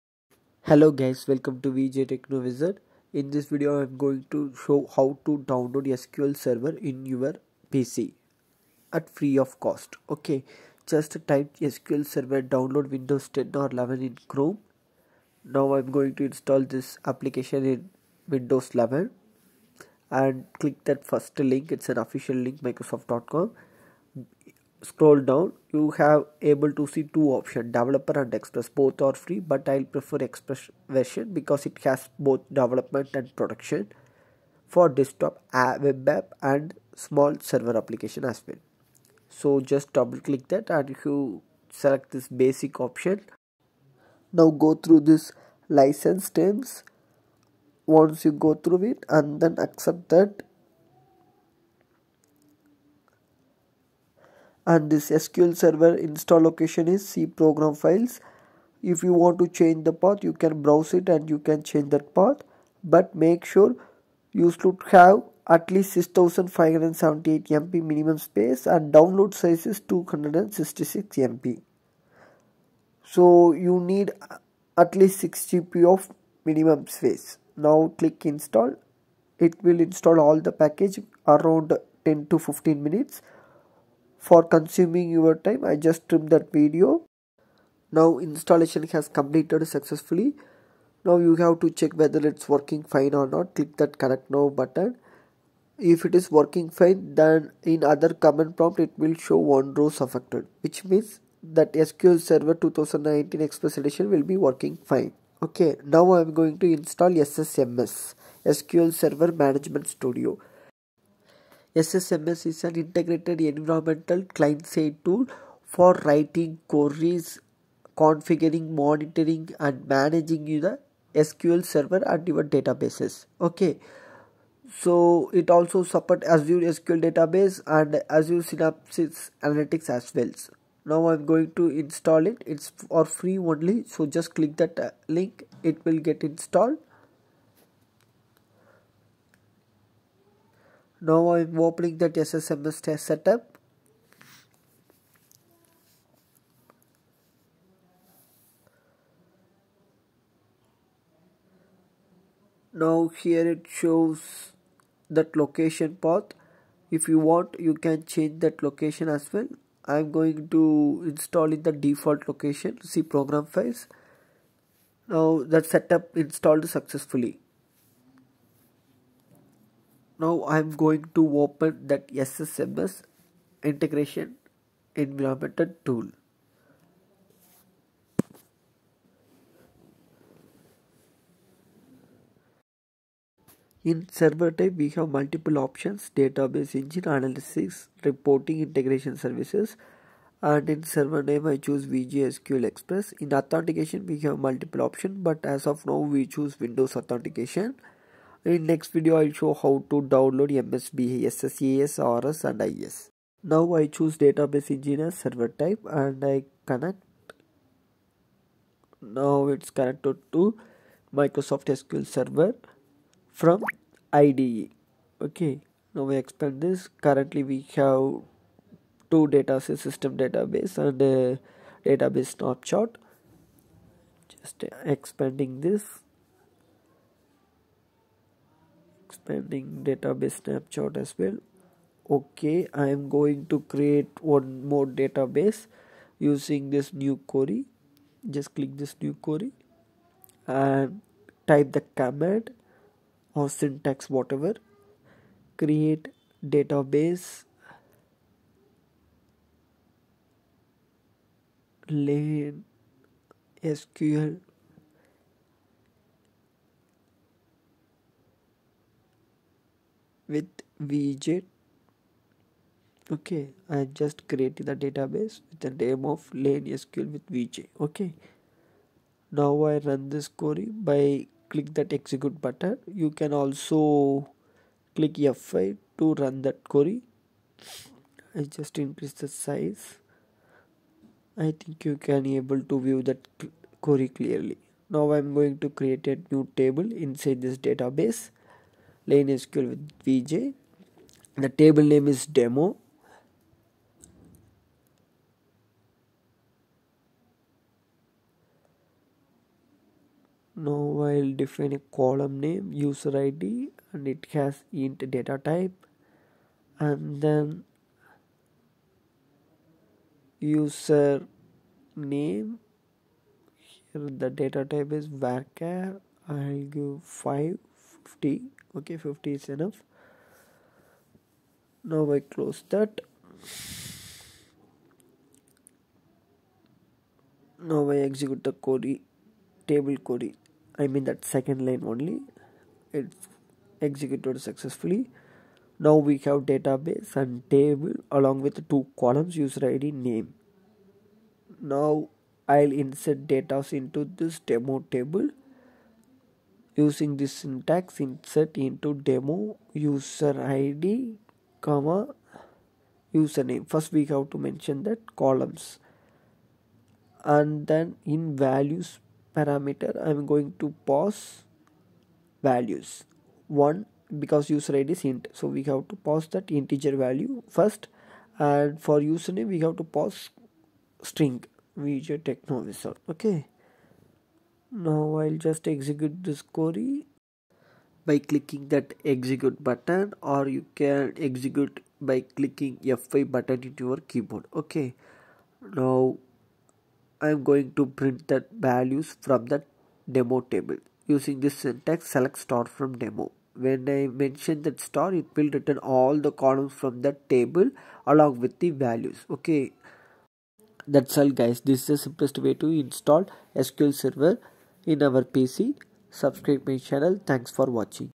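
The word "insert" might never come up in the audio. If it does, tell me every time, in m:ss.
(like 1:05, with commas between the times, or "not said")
5:42, 5:48.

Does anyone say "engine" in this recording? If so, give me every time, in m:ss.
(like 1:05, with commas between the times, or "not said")
3:06, 3:24.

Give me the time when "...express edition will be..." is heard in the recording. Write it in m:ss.
1:43.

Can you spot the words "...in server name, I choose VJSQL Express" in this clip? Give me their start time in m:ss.
3:10.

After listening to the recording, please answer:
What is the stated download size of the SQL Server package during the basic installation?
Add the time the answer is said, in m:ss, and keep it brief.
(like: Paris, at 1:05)
266 MB, at 1:09.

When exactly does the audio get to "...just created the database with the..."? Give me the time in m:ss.
4:23.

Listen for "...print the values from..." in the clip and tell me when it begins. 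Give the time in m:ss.
6:27.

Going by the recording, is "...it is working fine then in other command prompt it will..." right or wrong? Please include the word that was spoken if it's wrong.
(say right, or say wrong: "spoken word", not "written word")
right.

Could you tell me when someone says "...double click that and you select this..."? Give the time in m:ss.
0:39.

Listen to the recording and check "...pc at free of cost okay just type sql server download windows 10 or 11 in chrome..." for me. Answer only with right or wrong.
right.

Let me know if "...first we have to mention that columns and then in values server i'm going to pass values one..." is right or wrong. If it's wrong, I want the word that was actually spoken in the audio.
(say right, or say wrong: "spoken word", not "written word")
wrong: "parameter", not "server".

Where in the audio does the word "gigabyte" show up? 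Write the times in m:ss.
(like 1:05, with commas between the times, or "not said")
not said.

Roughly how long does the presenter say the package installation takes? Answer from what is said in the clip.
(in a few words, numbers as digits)
10 to 15 minutes.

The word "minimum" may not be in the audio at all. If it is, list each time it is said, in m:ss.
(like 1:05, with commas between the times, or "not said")
1:07, 1:16.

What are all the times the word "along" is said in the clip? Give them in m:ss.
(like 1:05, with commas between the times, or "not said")
5:38, 6:38.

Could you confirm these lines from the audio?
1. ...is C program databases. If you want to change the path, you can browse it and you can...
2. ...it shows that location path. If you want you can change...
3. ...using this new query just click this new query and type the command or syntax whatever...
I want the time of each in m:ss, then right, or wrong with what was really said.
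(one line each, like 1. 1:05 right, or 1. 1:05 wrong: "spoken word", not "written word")
1. 0:56 wrong: "files", not "databases"
2. 2:33 right
3. 3:56 right.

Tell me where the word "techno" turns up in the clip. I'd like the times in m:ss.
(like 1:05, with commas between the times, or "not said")
0:02, 6:12.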